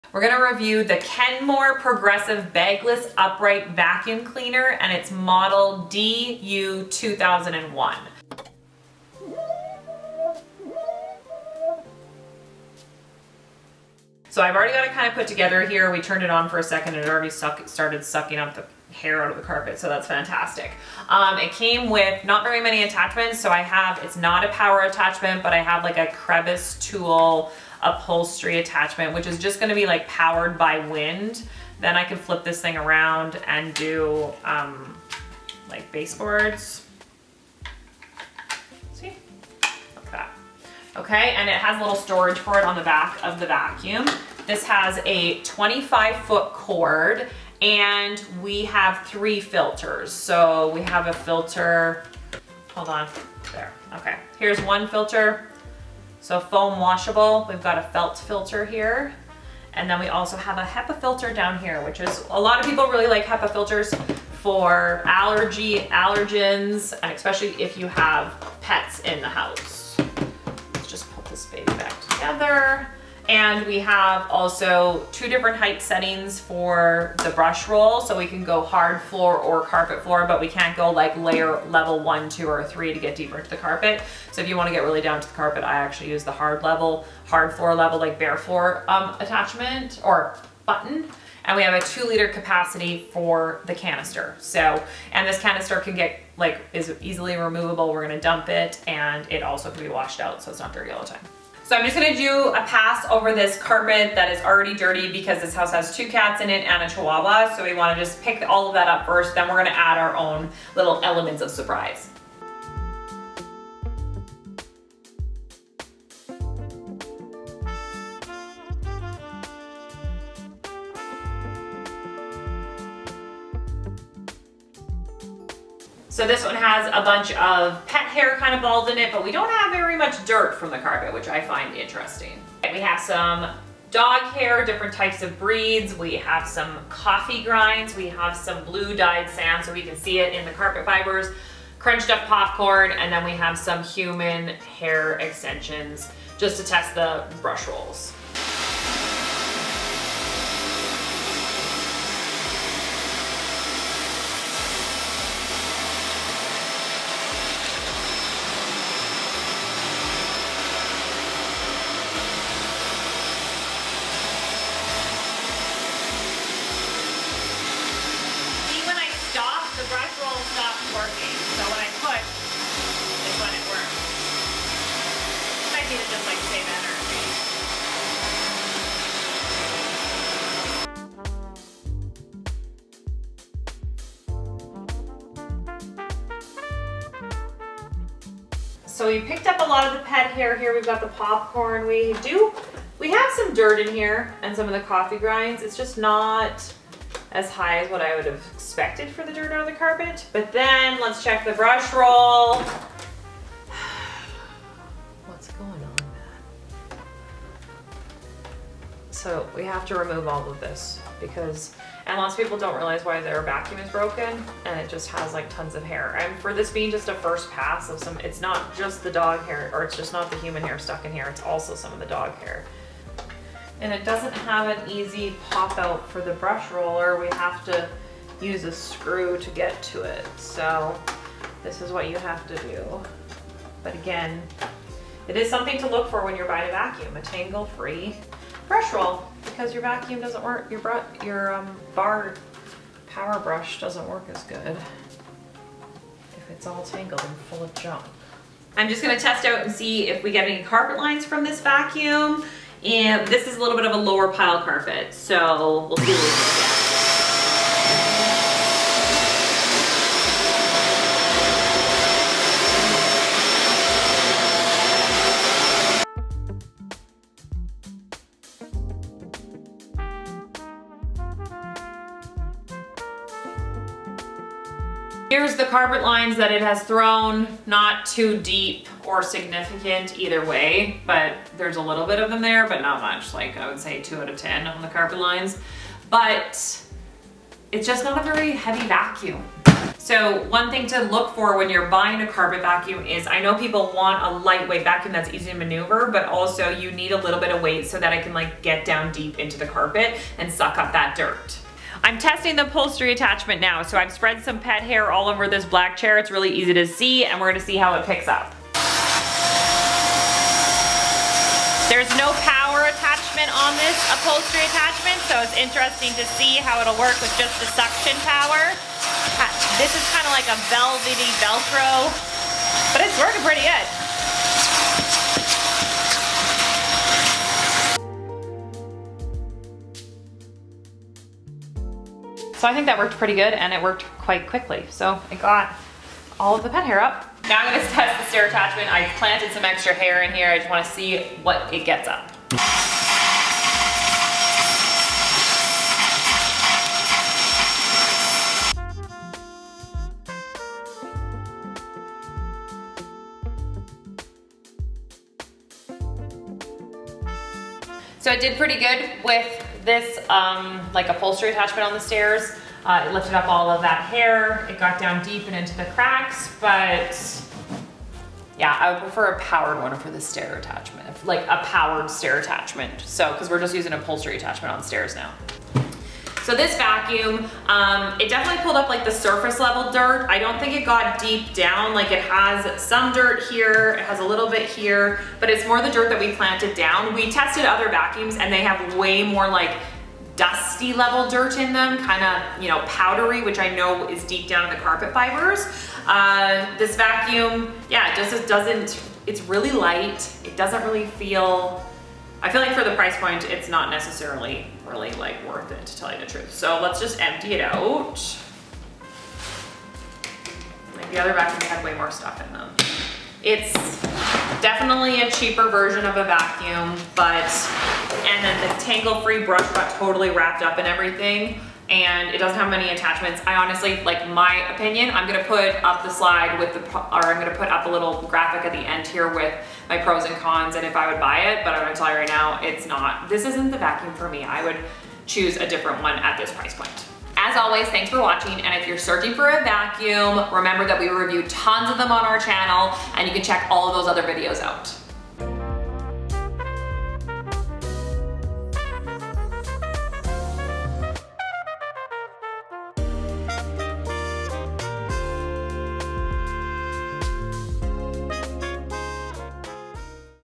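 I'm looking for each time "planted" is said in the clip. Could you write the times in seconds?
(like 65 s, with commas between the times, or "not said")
339 s, 386 s.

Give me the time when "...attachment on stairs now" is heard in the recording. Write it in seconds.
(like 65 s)
374 s.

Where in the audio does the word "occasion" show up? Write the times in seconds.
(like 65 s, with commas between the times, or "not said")
not said.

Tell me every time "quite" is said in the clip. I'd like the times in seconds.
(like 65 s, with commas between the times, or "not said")
334 s.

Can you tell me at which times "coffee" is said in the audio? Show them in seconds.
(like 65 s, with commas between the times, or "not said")
136 s, 194 s.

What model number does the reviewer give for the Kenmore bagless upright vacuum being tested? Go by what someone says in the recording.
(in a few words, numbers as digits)
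DU 2001.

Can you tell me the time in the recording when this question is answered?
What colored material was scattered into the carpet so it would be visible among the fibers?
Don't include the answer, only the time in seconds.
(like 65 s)
138 s.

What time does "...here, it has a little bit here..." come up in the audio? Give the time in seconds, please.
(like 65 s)
383 s.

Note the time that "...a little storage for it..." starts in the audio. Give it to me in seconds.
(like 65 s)
41 s.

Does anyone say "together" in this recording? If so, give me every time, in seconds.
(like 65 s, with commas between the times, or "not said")
15 s, 72 s.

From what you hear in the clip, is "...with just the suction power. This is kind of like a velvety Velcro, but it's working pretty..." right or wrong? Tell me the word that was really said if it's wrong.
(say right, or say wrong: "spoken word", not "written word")
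right.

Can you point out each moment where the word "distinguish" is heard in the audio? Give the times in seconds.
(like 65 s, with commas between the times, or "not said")
not said.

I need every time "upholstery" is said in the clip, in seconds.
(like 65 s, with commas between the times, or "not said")
27 s, 302 s, 314 s, 361 s, 373 s.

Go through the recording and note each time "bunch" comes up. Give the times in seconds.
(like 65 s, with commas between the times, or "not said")
127 s.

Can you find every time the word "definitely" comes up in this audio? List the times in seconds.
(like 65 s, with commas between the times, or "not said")
378 s, 414 s.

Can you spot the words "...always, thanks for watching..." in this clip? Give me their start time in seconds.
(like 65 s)
437 s.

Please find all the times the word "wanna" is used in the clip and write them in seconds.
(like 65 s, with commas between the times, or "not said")
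84 s, 107 s, 340 s.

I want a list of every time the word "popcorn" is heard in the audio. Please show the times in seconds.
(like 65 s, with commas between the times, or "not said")
142 s, 191 s.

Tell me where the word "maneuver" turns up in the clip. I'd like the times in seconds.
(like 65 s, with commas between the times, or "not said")
295 s.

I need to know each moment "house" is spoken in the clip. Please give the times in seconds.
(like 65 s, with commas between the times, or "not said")
69 s, 105 s.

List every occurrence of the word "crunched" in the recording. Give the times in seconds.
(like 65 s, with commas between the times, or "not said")
141 s.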